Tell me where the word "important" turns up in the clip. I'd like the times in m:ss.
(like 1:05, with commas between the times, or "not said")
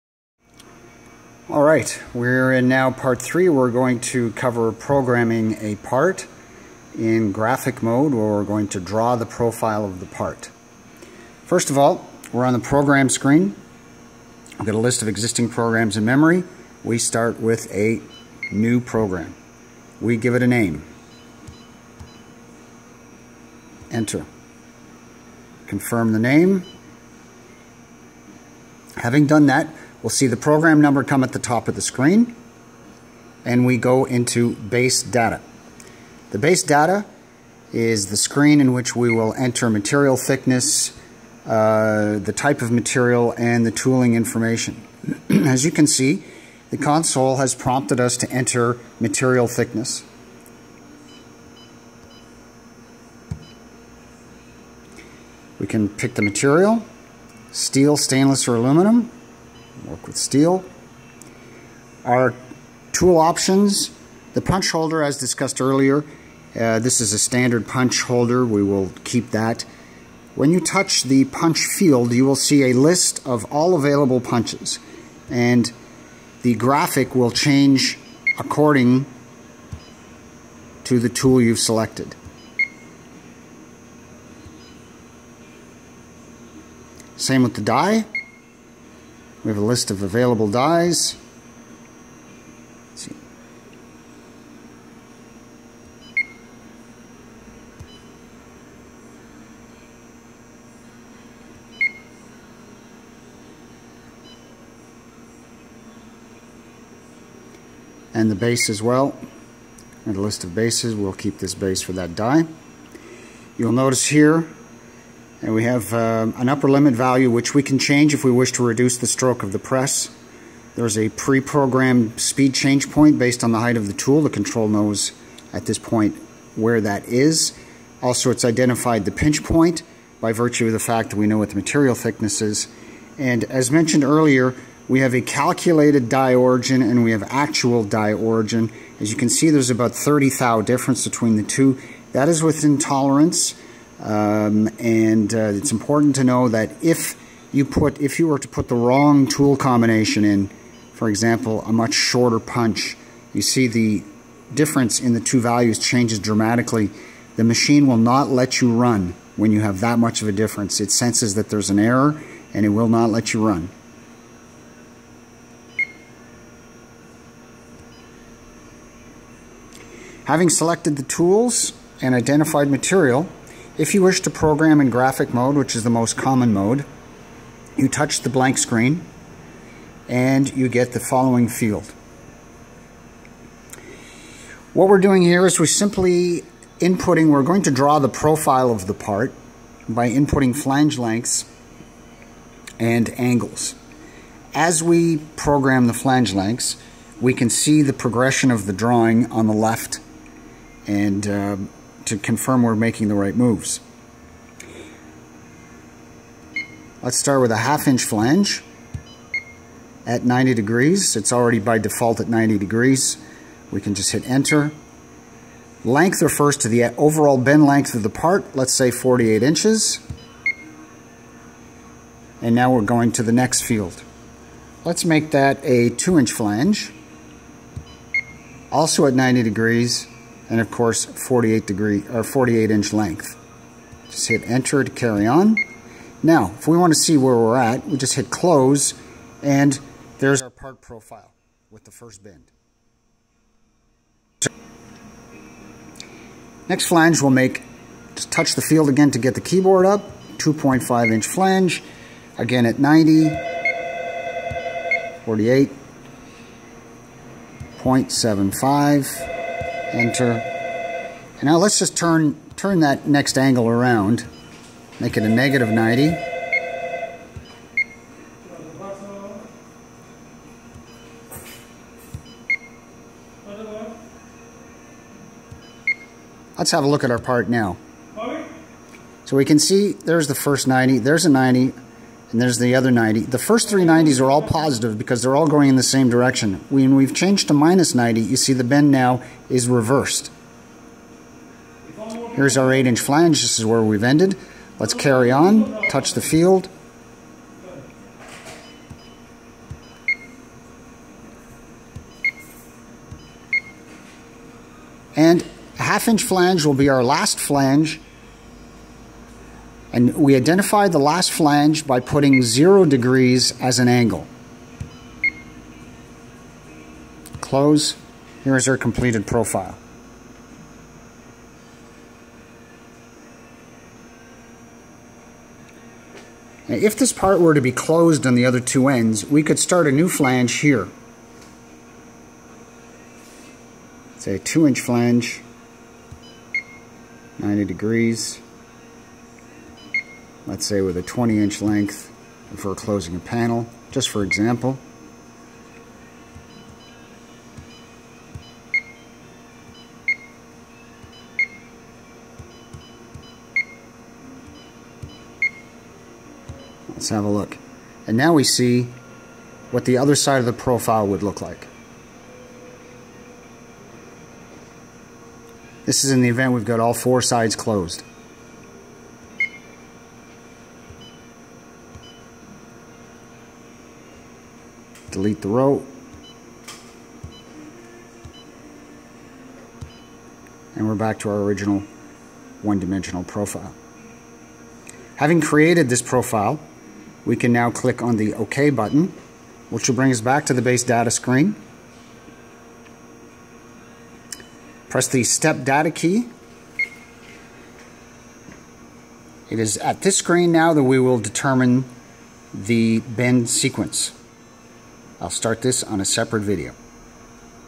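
2:25.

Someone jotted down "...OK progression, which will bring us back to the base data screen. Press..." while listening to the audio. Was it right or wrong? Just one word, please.
wrong.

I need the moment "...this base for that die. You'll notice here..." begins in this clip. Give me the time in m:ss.
1:51.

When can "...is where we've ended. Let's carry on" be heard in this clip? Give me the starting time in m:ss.
4:53.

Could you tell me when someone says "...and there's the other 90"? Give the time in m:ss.
4:42.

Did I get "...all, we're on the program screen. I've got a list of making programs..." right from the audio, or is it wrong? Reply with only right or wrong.
wrong.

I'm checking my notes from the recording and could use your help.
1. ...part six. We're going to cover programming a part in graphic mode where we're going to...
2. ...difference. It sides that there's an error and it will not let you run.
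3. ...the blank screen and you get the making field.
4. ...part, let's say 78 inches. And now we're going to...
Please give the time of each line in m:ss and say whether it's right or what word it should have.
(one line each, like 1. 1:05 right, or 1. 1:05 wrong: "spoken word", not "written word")
1. 0:02 wrong: "three", not "six"
2. 2:40 wrong: "senses", not "sides"
3. 2:58 wrong: "following", not "making"
4. 3:38 wrong: "48", not "78".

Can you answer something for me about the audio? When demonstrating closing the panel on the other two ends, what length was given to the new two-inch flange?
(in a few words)
20 inches.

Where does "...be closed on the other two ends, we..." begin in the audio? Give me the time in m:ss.
5:27.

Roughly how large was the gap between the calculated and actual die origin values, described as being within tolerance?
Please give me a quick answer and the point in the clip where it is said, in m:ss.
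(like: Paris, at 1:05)
30 thou, at 2:19.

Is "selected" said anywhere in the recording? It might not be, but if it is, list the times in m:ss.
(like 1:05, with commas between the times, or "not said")
1:21, 2:50.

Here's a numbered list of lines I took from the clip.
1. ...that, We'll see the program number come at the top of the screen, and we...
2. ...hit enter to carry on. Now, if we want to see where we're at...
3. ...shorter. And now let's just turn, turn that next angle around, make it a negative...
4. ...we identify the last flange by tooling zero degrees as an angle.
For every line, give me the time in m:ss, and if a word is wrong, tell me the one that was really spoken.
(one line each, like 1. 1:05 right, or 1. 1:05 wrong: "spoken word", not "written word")
1. 0:29 right
2. 3:54 right
3. 4:19 wrong: "enter", not "shorter"
4. 5:10 wrong: "putting", not "tooling".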